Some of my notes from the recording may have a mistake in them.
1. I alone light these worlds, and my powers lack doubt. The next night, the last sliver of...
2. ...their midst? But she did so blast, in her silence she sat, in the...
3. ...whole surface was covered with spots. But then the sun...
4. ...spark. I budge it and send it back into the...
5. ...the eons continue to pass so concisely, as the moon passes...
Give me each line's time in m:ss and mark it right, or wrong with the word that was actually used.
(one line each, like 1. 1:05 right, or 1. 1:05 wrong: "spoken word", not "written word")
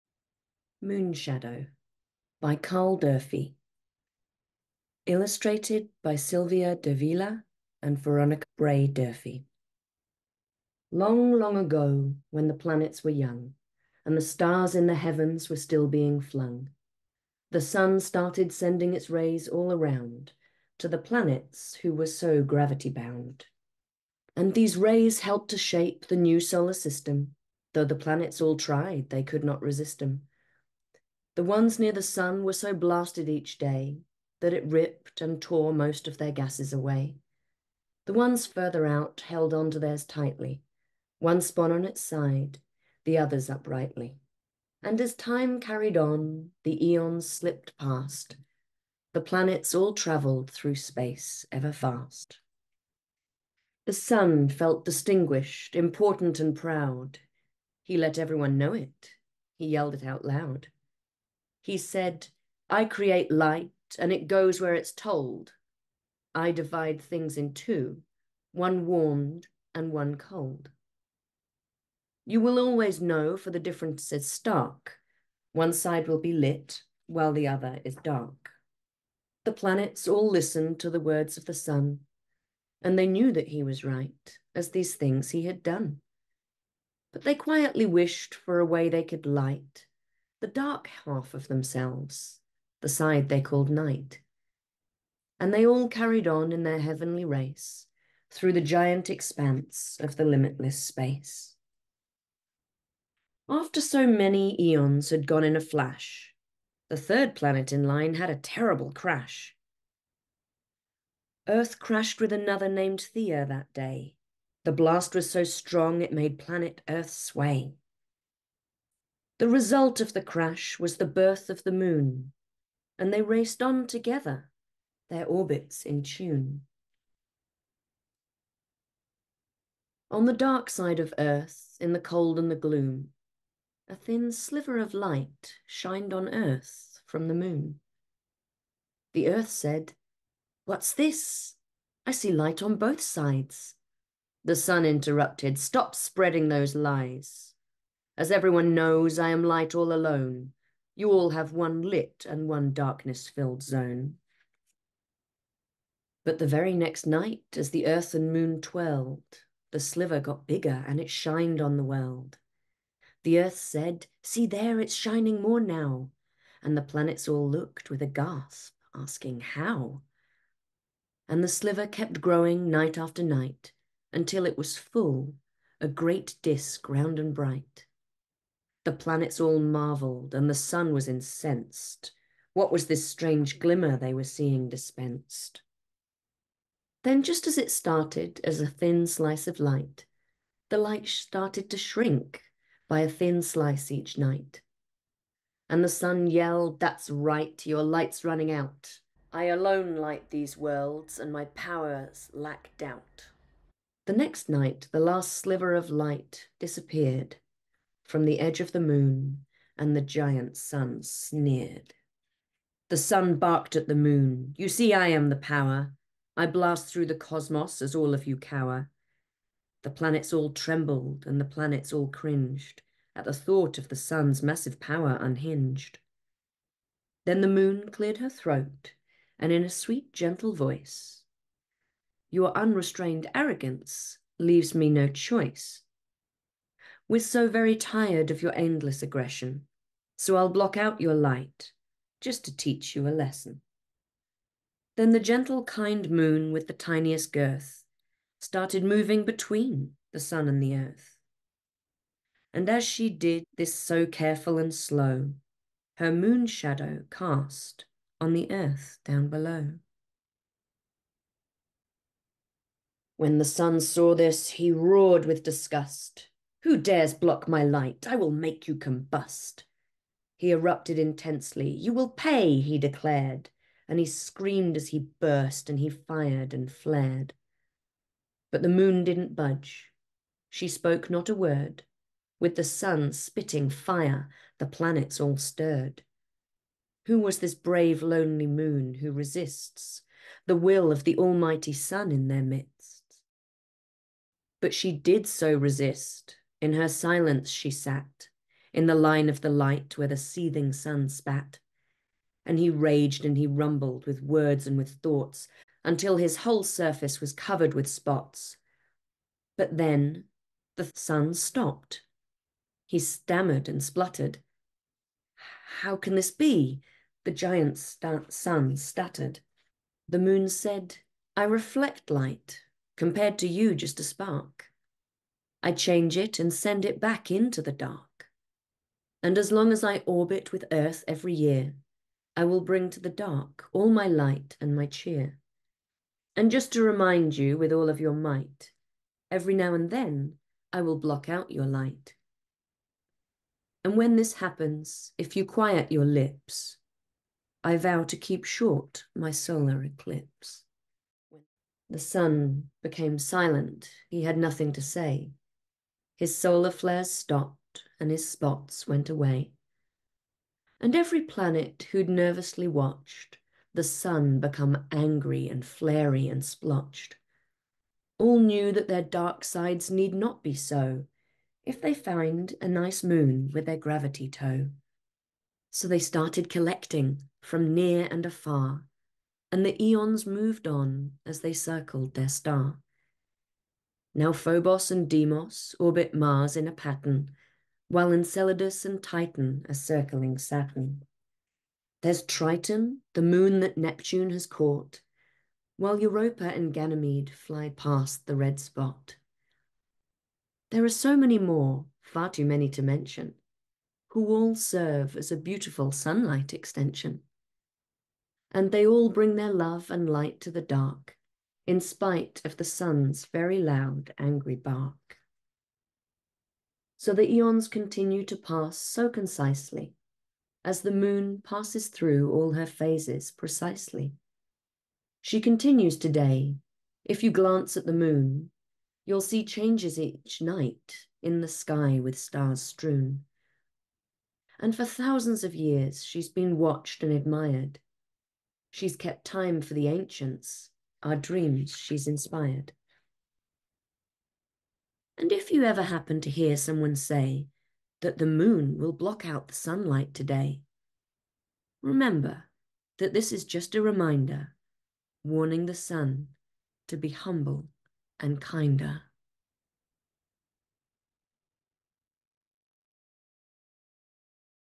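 1. 3:19 right
2. 4:52 wrong: "resist", not "blast"
3. 5:06 right
4. 5:24 wrong: "change", not "budge"
5. 6:57 right.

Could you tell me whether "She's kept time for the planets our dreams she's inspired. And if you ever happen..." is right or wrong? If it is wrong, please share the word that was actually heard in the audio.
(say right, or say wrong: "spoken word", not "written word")
wrong: "ancients", not "planets".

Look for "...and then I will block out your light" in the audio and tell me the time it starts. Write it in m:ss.
5:39.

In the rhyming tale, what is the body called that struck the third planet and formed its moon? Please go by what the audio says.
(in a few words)
Thea.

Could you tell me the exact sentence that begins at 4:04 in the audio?
Then the gentle, kind moon with the tiniest girth started moving between the sun and the earth.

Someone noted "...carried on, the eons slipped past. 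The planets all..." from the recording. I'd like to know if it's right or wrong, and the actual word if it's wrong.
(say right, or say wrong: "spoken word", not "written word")
right.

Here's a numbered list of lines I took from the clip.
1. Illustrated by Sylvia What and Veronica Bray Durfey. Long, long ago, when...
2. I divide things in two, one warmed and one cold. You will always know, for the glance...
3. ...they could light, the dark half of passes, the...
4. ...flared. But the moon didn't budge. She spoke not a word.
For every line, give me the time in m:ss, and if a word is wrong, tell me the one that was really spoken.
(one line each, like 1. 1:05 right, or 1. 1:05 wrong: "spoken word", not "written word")
1. 0:05 wrong: "Davila", not "What"
2. 1:06 wrong: "difference", not "glance"
3. 1:28 wrong: "themselves", not "passes"
4. 4:36 right.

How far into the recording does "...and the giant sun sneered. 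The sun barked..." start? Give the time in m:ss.
3:29.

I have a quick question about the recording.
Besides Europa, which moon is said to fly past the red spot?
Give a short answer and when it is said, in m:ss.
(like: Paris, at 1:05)
Ganymede, at 6:36.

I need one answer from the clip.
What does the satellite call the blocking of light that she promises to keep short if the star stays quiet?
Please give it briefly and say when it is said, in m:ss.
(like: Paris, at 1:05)
solar eclipse, at 5:49.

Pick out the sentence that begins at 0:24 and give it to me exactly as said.
And these rays helped to shape the new solar system, though the planets all tried, they could not resist them.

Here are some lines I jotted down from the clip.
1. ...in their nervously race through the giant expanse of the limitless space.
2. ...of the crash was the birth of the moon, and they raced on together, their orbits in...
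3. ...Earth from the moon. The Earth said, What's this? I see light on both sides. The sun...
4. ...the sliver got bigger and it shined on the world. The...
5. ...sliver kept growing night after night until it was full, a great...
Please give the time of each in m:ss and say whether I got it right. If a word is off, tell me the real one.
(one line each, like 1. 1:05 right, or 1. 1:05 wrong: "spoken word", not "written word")
1. 1:36 wrong: "heavenly", not "nervously"
2. 1:59 right
3. 2:16 right
4. 2:39 right
5. 2:51 right.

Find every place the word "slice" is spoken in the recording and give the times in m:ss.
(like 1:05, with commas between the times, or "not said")
3:09, 3:13.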